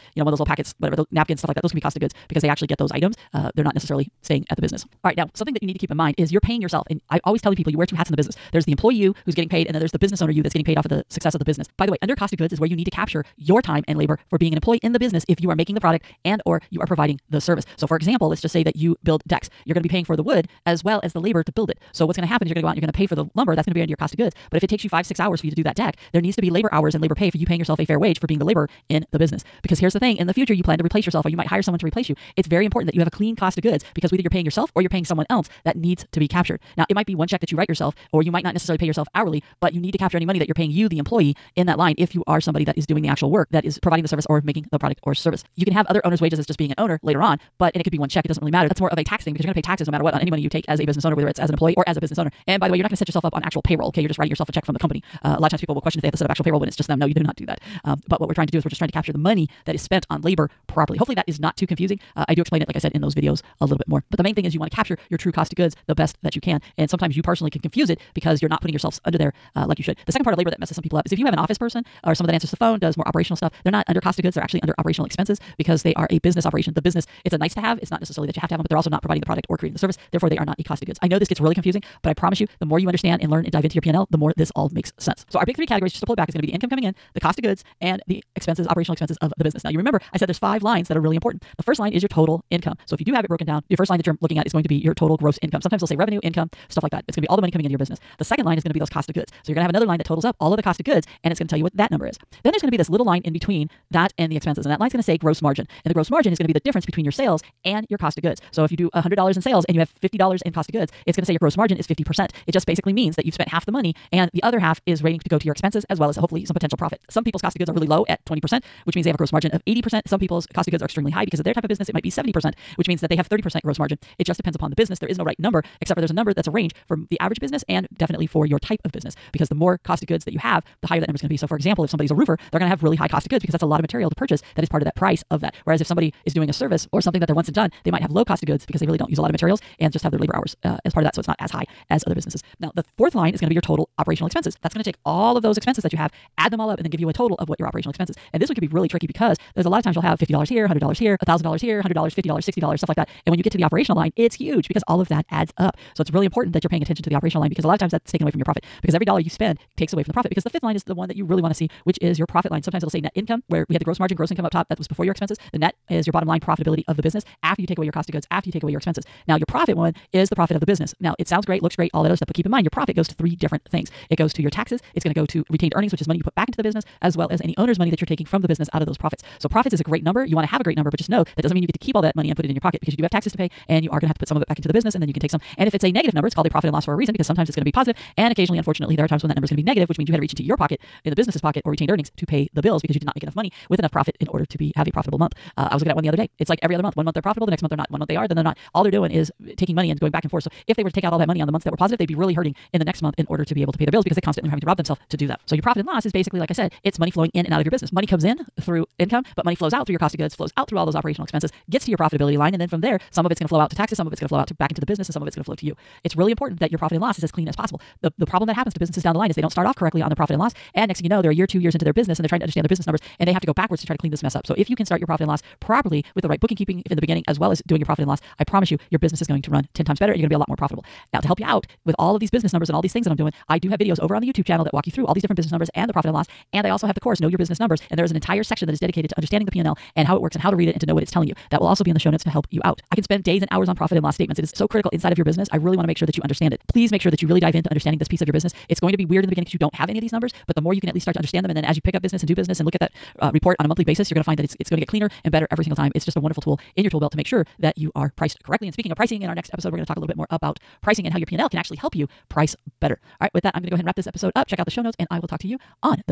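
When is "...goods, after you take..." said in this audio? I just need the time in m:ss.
2:48.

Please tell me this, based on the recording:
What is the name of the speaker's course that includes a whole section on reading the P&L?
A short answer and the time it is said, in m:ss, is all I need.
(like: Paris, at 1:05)
Know Your Business Numbers, at 3:57.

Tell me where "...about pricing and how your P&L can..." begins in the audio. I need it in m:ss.
4:20.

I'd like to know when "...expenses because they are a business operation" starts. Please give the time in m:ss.
1:15.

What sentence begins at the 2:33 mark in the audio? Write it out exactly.
And when you get to the operational line, it's huge because all of that adds up.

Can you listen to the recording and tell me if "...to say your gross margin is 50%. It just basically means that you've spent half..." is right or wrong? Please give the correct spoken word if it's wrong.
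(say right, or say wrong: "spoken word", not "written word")
right.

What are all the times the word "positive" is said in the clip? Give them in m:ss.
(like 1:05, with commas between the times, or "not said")
3:07, 3:21.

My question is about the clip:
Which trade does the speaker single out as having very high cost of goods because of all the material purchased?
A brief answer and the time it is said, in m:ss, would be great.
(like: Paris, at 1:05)
roofer, at 2:12.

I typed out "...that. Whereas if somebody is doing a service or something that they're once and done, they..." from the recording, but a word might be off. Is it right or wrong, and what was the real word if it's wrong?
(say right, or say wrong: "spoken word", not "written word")
right.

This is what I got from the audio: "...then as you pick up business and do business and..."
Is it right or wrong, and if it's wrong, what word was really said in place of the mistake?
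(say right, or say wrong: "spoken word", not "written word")
right.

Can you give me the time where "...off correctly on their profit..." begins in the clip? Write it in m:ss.
3:39.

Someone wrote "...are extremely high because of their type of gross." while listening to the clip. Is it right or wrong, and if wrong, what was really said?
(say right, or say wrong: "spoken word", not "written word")
wrong: "business", not "gross".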